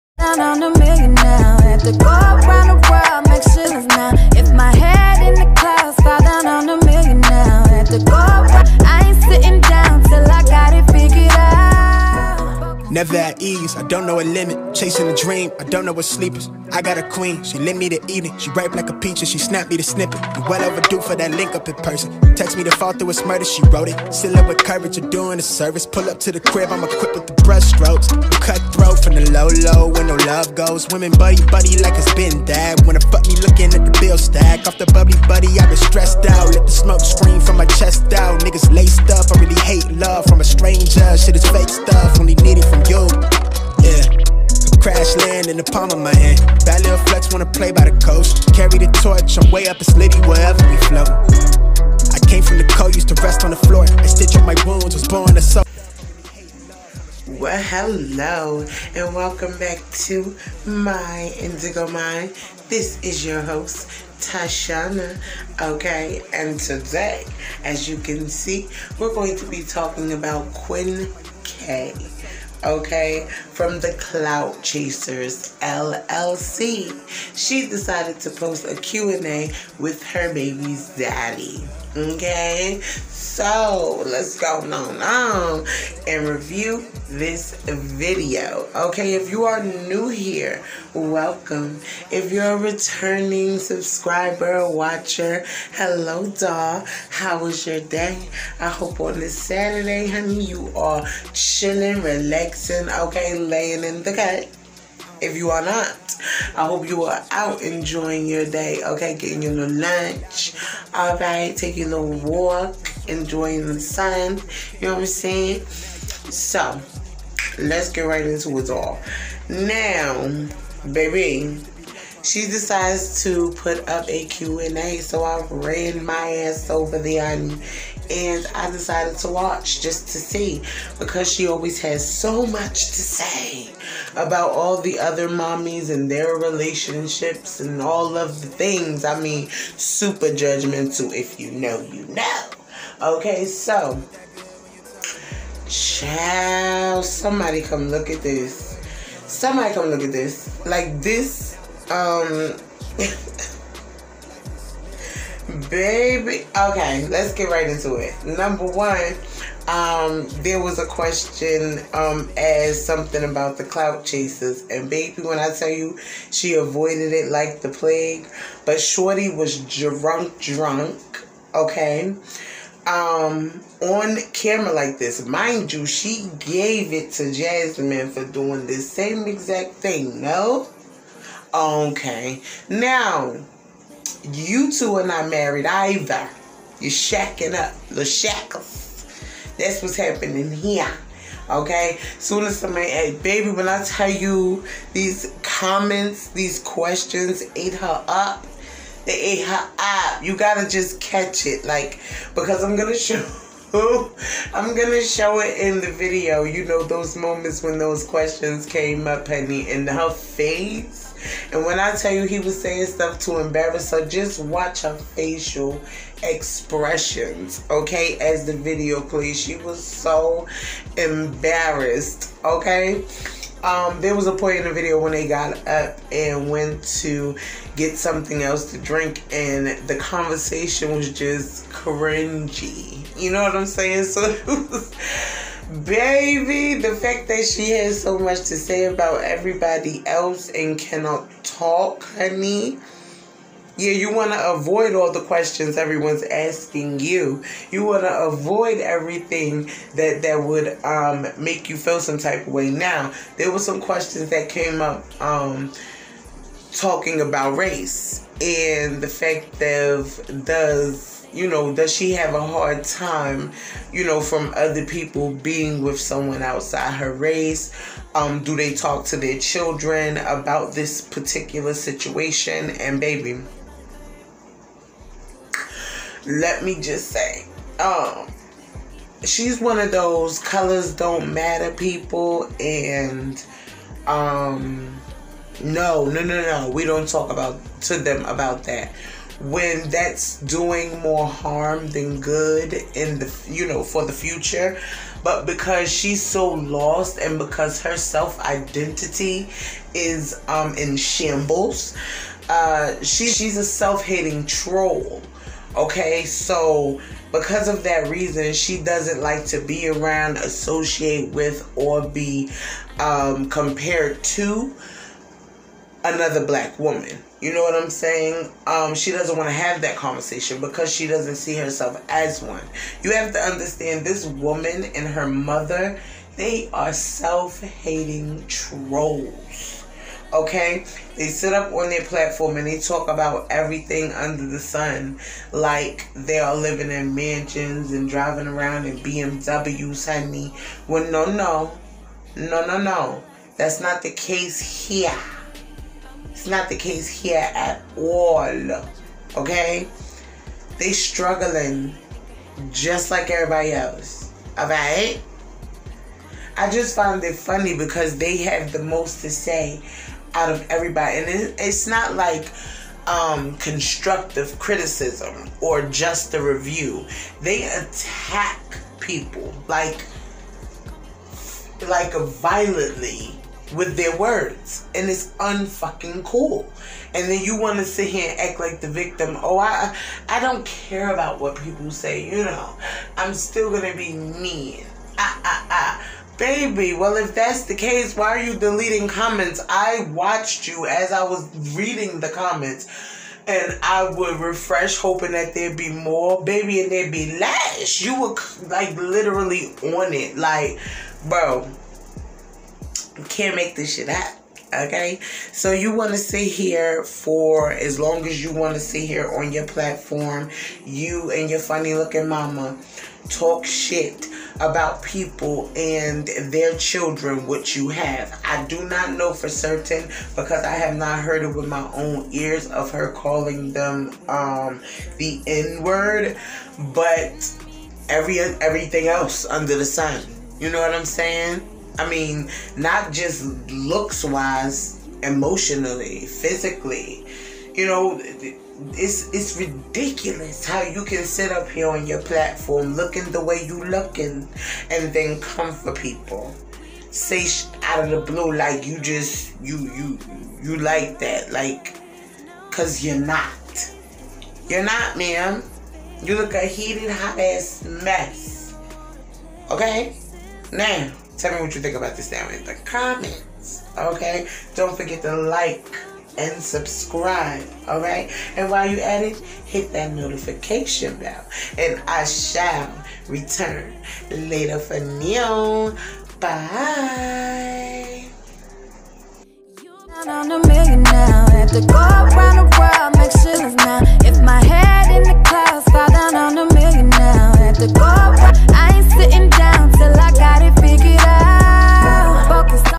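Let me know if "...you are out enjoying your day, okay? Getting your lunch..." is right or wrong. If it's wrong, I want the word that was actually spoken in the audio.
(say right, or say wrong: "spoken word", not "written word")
right.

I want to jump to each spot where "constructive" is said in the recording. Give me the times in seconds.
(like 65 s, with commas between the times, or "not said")
363 s.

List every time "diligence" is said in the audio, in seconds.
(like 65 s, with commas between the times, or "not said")
not said.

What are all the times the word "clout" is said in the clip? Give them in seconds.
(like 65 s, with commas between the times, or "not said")
73 s, 163 s.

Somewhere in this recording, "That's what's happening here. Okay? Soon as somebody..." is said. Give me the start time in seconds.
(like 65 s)
189 s.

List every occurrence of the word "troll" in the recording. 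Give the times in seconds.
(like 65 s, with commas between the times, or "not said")
304 s, 328 s.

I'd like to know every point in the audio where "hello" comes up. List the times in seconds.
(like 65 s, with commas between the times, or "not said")
57 s, 95 s.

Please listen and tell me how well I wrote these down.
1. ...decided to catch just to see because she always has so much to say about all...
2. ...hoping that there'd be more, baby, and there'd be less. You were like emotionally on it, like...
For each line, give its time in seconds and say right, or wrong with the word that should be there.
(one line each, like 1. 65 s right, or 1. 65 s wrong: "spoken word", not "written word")
1. 128 s wrong: "watch", not "catch"
2. 394 s wrong: "literally", not "emotionally".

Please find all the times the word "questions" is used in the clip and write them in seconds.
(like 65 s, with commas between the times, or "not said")
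160 s, 196 s, 208 s, 245 s, 253 s.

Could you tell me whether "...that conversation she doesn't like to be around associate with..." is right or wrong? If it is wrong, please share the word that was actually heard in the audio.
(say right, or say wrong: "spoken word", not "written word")
wrong: "reason", not "conversation".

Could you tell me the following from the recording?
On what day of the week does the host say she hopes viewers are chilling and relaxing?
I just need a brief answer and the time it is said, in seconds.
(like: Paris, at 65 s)
Saturday, at 99 s.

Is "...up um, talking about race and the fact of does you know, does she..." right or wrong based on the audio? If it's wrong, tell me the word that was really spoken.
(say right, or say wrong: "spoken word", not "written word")
right.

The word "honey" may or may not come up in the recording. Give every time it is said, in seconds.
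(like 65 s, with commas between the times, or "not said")
100 s, 209 s, 242 s, 340 s.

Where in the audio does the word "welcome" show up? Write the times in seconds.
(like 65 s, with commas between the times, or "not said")
59 s, 90 s.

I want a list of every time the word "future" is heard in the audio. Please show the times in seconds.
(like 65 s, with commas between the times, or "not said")
294 s.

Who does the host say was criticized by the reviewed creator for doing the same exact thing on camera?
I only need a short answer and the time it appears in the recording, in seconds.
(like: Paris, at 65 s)
Jasmine, at 177 s.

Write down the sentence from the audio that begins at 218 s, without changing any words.
As the video plays, she was so embarrassed, okay?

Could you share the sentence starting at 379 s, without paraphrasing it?
Oh, I I don't care about what people say.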